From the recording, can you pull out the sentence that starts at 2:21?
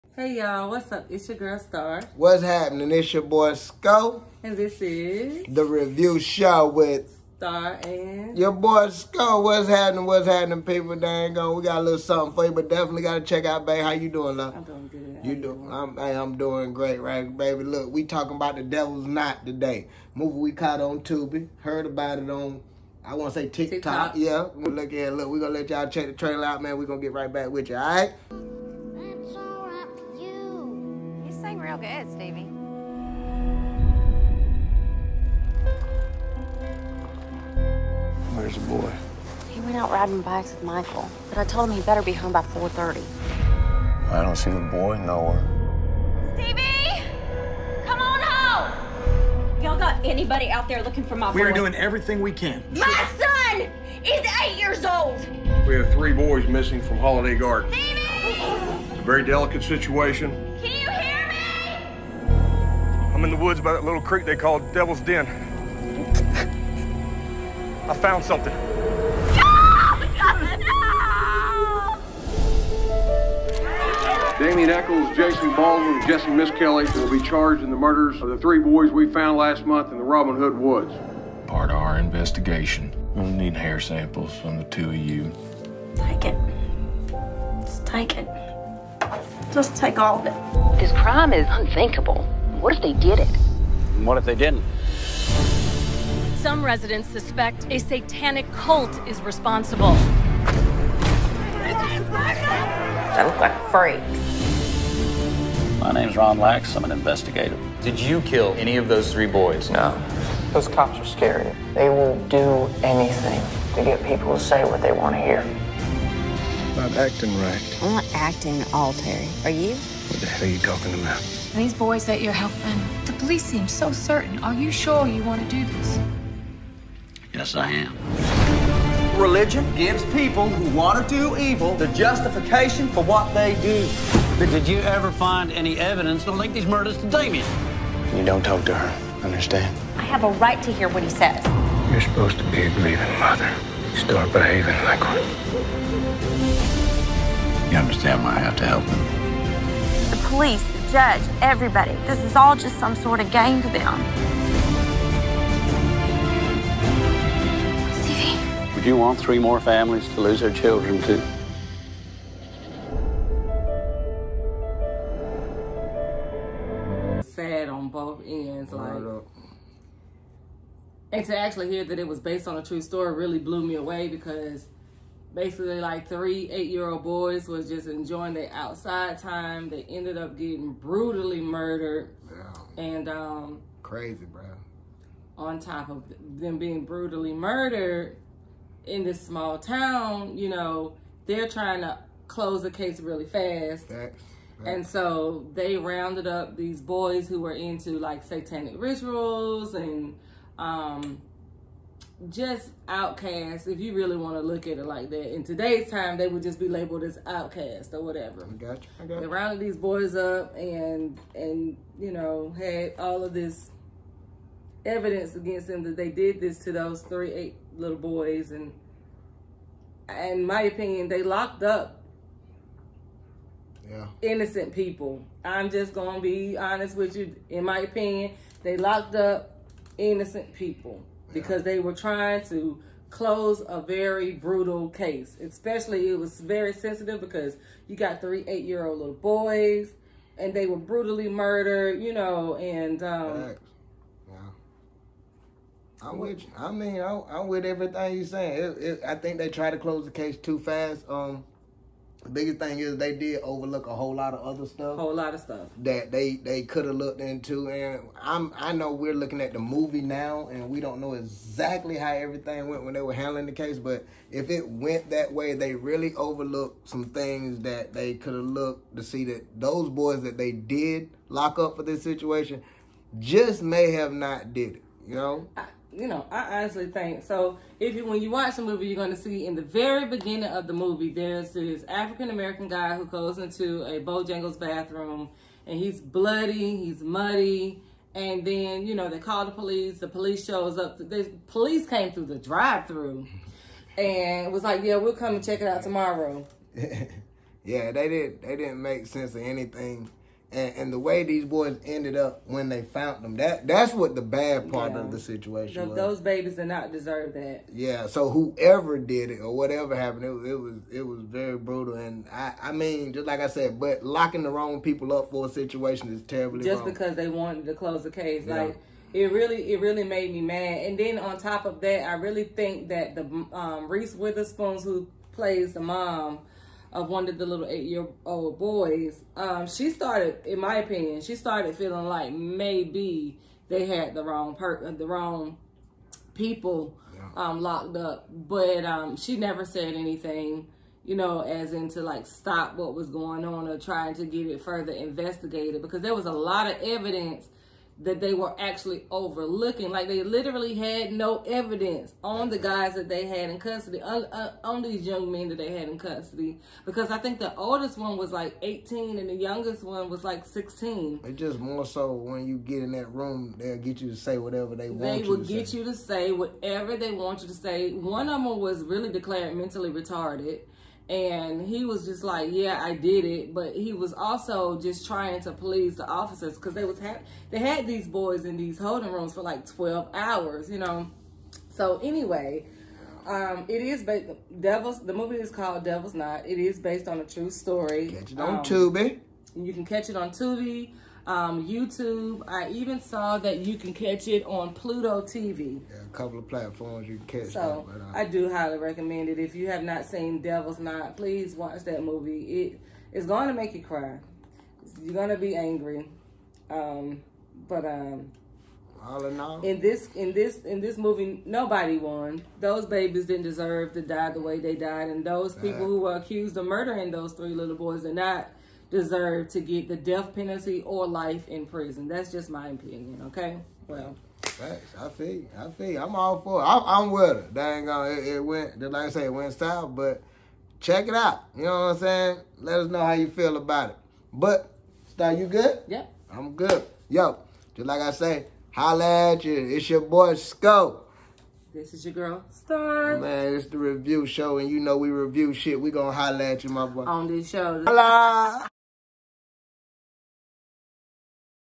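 You're supposed to be a grieving mother.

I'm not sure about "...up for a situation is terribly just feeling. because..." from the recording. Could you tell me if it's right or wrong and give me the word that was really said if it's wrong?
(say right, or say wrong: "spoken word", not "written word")
wrong: "wrong", not "feeling".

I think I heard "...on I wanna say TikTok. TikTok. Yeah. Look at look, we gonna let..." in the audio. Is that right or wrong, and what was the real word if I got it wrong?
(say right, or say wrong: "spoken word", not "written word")
right.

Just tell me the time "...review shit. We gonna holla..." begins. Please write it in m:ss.
7:25.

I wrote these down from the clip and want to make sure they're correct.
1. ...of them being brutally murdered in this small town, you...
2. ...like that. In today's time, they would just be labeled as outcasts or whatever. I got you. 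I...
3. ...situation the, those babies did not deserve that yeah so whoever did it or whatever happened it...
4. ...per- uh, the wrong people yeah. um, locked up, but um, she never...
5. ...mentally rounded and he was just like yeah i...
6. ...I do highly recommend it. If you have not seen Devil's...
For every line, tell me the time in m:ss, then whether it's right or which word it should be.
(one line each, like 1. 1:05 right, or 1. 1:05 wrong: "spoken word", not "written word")
1. 3:05 right
2. 3:24 right
3. 5:05 right
4. 5:34 right
5. 6:09 wrong: "retarded", not "rounded"
6. 6:38 right.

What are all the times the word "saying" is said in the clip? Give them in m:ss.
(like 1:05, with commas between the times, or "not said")
4:08, 7:11.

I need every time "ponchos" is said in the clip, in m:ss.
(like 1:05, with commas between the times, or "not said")
not said.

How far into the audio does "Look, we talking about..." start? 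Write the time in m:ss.
0:17.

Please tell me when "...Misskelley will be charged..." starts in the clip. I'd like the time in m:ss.
1:16.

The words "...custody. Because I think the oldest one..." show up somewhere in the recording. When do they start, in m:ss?
5:55.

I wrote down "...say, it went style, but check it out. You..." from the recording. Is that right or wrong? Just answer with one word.
right.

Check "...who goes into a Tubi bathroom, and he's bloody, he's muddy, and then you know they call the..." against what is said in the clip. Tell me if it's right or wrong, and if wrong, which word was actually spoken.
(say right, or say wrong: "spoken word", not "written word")
wrong: "Bojangles", not "Tubi".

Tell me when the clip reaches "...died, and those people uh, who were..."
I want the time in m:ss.
6:54.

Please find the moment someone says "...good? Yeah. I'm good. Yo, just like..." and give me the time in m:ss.
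7:15.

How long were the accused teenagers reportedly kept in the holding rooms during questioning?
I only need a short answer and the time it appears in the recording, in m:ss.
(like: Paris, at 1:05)
12 hours, at 6:19.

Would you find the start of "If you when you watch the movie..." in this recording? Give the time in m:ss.
4:37.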